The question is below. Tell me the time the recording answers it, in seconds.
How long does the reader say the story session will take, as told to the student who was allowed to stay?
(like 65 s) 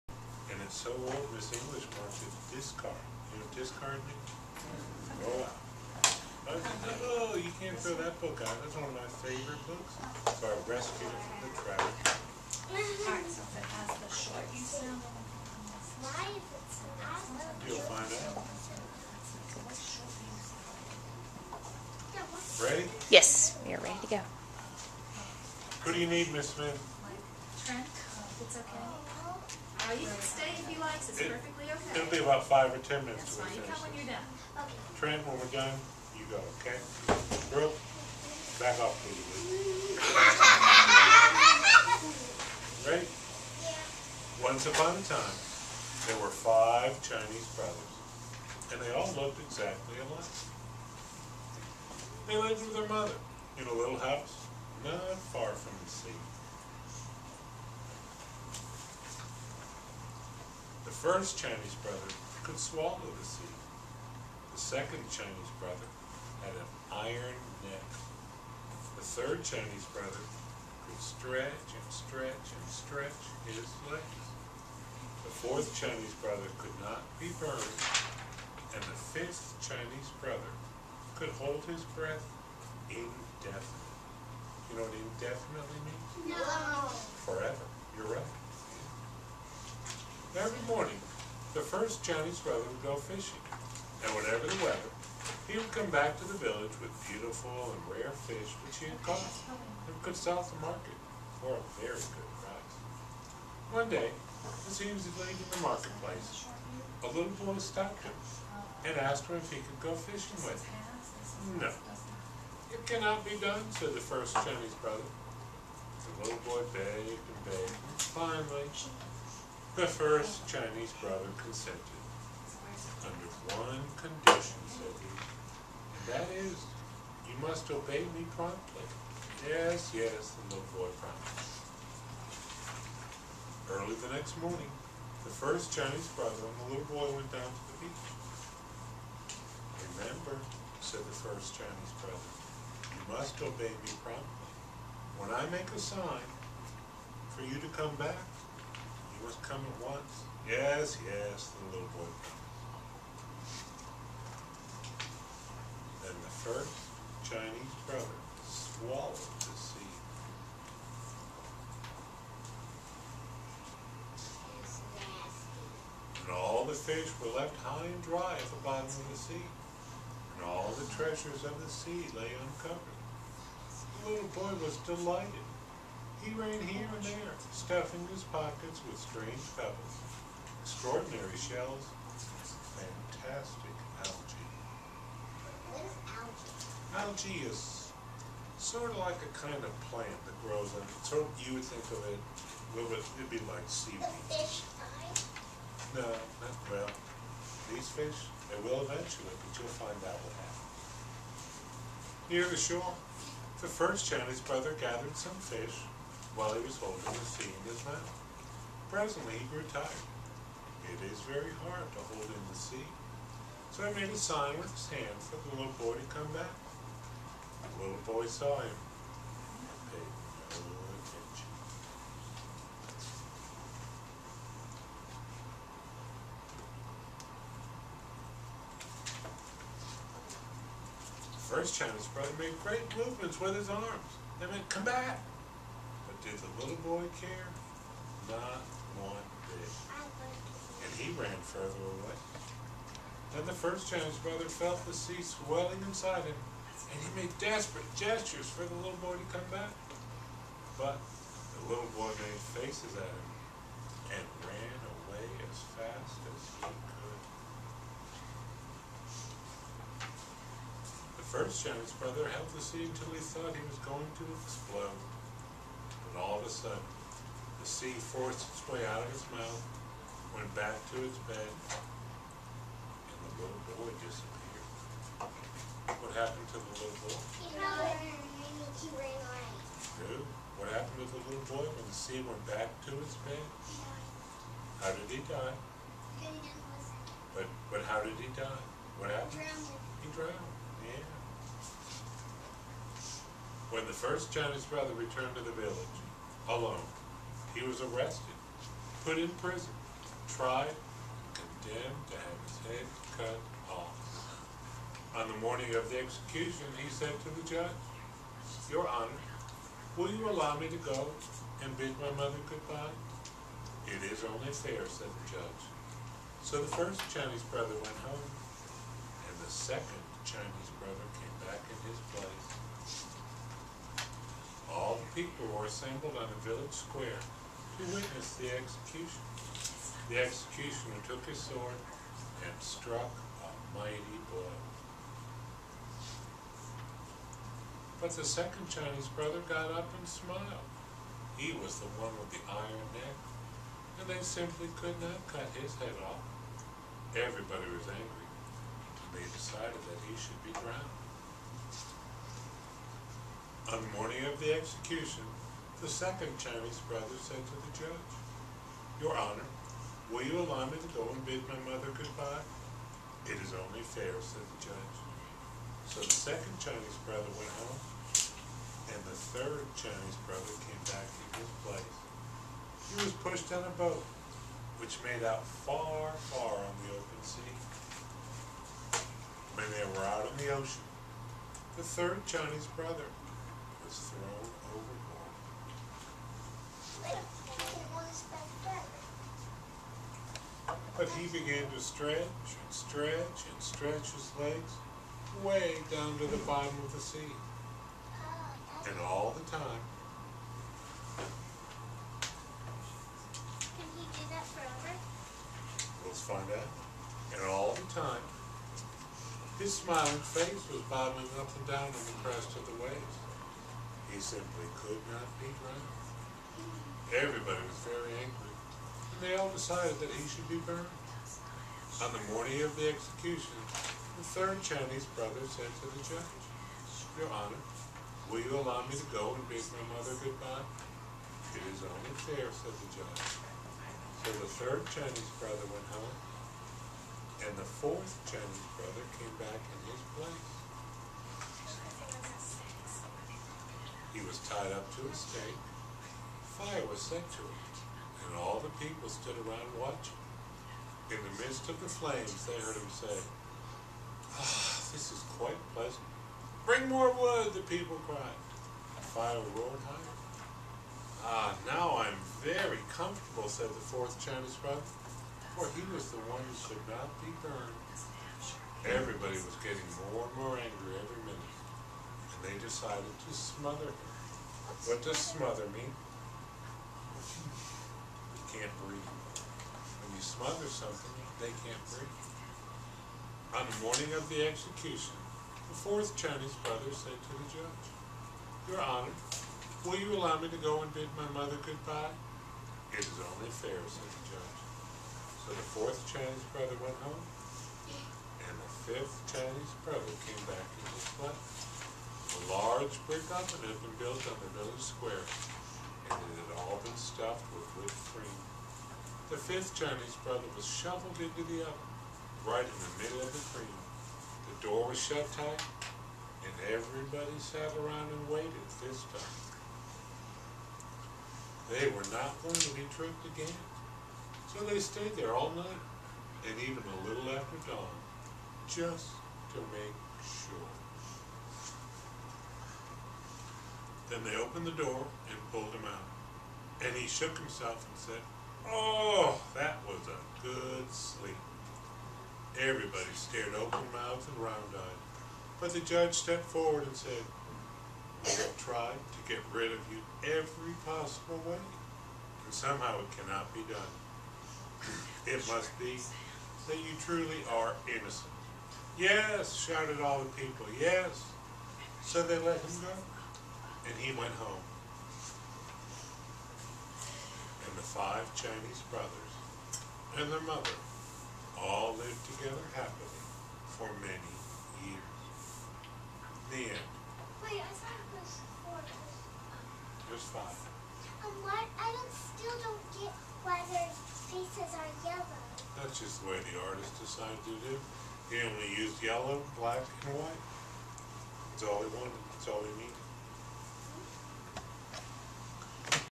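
32 s.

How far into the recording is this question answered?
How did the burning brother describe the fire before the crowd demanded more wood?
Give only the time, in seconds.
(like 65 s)
455 s.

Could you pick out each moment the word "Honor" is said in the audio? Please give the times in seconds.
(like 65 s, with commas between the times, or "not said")
308 s, 359 s, 427 s, 488 s.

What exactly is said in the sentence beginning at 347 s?
Everybody was angry, and they decided that he should be drowned.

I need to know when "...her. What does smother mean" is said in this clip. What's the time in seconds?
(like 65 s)
473 s.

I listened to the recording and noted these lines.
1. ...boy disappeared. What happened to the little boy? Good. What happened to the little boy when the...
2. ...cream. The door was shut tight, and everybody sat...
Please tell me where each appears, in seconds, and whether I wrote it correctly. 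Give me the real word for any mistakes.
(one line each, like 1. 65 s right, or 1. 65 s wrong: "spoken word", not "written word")
1. 273 s right
2. 513 s right.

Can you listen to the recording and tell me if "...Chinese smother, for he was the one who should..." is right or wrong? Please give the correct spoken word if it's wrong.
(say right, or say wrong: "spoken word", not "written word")
wrong: "brother", not "smother".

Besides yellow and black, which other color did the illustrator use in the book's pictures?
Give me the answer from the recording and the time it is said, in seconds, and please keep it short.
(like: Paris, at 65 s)
White, at 590 s.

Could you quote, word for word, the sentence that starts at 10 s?
So I rescued it from the trash.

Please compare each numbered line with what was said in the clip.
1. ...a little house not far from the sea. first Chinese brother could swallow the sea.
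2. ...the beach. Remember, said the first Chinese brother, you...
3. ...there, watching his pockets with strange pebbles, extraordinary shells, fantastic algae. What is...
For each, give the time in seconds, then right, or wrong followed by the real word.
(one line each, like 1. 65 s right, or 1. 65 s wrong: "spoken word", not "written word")
1. 53 s right
2. 137 s right
3. 177 s wrong: "stuffing", not "watching".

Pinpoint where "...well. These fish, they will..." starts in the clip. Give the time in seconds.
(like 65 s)
196 s.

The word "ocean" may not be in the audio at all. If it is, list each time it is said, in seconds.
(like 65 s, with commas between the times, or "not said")
380 s.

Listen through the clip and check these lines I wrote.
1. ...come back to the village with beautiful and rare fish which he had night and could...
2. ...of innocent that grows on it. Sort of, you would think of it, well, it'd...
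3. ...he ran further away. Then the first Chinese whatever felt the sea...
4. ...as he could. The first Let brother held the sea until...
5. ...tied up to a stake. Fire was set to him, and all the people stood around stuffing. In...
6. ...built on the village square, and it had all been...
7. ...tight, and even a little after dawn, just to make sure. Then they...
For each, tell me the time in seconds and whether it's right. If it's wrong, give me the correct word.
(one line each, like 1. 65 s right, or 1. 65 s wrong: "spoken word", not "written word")
1. 95 s wrong: "caught", not "night"
2. 189 s wrong: "plant", not "innocent"
3. 240 s wrong: "brother", not "whatever"
4. 256 s wrong: "Chinese", not "Let"
5. 444 s wrong: "watching", not "stuffing"
6. 503 s right
7. 525 s wrong: "night", not "tight".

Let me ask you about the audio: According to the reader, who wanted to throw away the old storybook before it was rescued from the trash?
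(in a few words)
Miss English.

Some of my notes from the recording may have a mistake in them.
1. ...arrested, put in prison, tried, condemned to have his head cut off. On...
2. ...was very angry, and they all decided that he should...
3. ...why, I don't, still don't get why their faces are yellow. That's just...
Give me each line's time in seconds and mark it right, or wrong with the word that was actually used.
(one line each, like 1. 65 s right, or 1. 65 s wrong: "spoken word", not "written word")
1. 297 s right
2. 417 s right
3. 581 s right.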